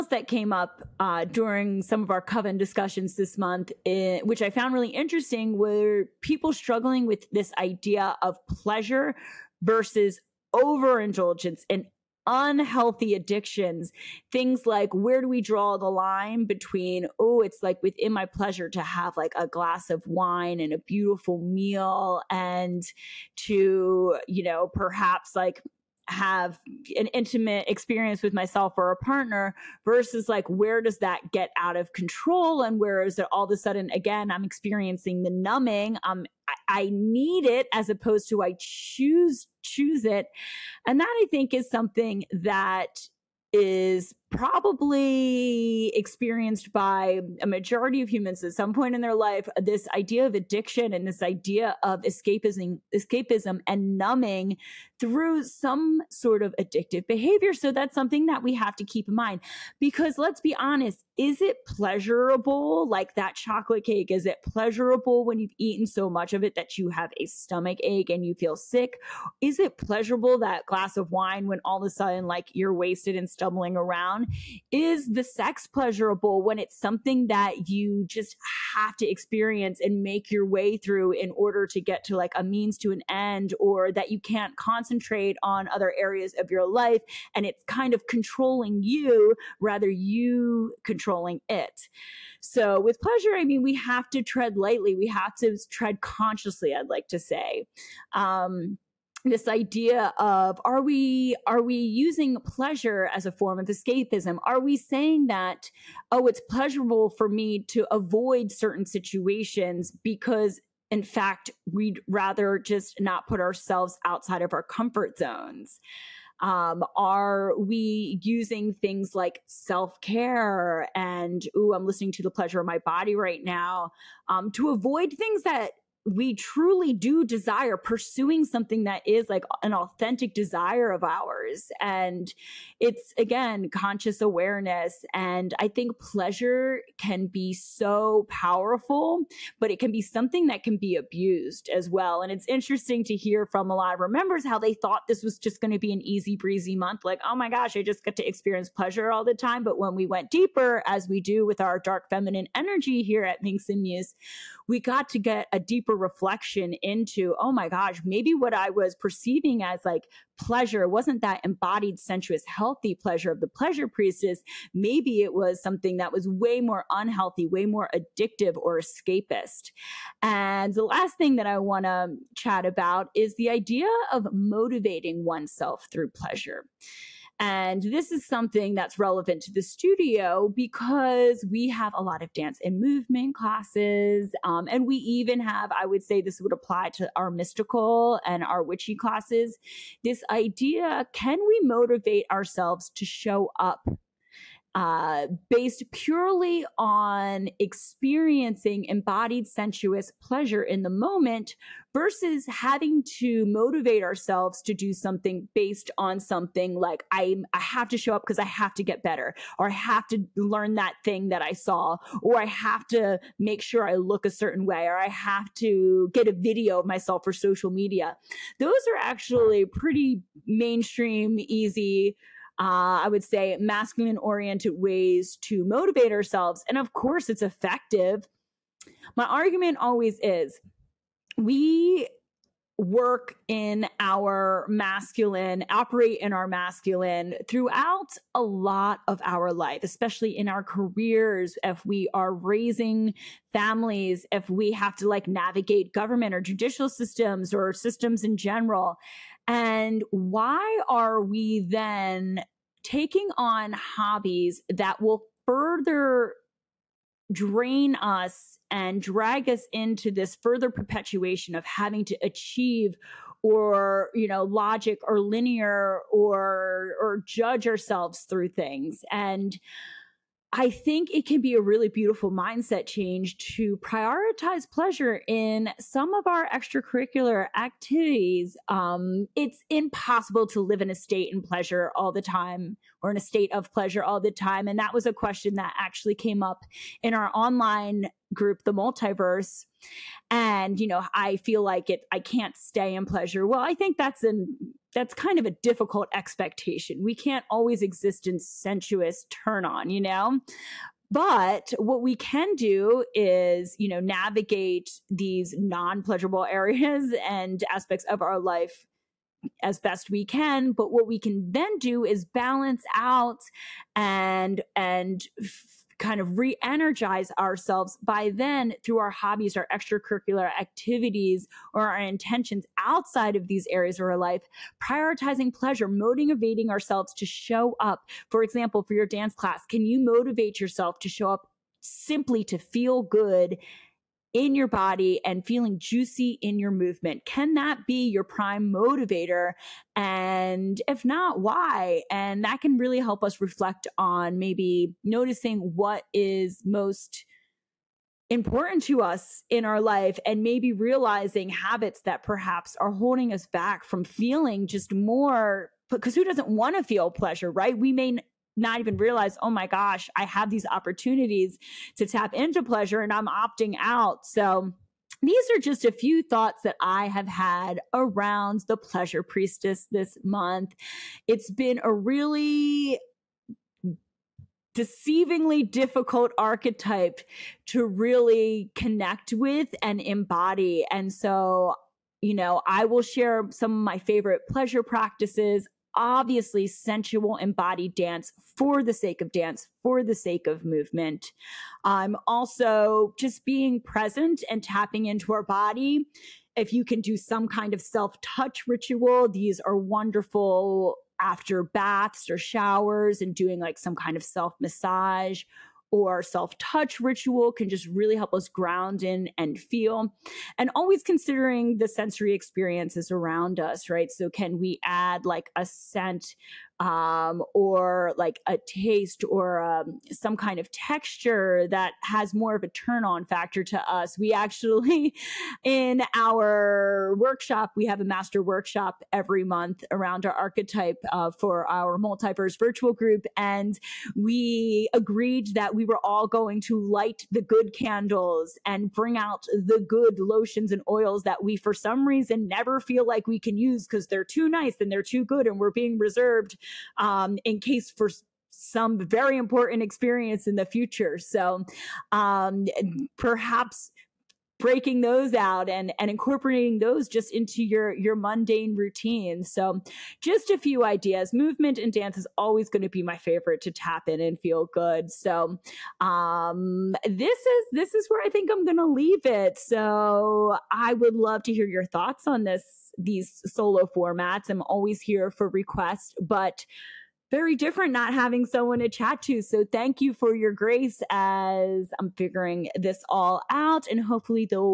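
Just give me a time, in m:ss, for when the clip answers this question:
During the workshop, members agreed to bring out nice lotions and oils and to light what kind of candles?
7:17.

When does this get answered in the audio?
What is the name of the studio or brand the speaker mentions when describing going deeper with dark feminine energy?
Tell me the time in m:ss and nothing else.
2:33.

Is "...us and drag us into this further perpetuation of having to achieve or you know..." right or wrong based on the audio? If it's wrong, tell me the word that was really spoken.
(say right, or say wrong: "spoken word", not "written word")
right.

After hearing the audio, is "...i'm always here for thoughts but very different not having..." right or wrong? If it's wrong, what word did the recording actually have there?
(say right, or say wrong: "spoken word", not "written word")
wrong: "requests", not "thoughts".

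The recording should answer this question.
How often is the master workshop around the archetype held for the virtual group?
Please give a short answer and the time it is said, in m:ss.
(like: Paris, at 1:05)
every month, at 7:09.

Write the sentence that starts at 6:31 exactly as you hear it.
Um, also, just being present and tapping into our body.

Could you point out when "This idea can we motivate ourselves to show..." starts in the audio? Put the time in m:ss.
3:10.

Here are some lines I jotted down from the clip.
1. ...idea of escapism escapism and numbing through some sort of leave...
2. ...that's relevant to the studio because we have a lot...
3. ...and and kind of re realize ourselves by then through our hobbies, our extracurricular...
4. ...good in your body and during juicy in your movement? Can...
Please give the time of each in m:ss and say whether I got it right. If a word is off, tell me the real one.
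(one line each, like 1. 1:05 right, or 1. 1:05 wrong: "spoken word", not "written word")
1. 0:51 wrong: "addictive", not "leave"
2. 2:58 right
3. 5:13 wrong: "energize", not "realize"
4. 5:33 wrong: "feeling", not "during".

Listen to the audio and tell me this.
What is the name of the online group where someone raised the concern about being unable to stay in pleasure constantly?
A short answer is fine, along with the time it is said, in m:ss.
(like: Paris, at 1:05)
the multiverse, at 4:48.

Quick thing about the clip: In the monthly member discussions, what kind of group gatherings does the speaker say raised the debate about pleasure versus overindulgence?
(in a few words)
coven discussions.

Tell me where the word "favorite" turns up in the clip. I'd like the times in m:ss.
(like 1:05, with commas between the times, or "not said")
6:23, 7:43.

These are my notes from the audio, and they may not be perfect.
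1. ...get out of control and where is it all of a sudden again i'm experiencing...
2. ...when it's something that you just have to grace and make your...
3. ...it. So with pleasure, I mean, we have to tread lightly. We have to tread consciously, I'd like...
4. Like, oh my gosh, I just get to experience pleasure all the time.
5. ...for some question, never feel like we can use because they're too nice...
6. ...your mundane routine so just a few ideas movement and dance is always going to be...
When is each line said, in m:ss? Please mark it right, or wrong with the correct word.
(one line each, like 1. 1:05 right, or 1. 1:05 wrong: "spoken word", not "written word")
1. 0:31 right
2. 1:16 wrong: "experience", not "grace"
3. 1:31 right
4. 2:27 right
5. 7:21 wrong: "reason", not "question"
6. 7:37 right.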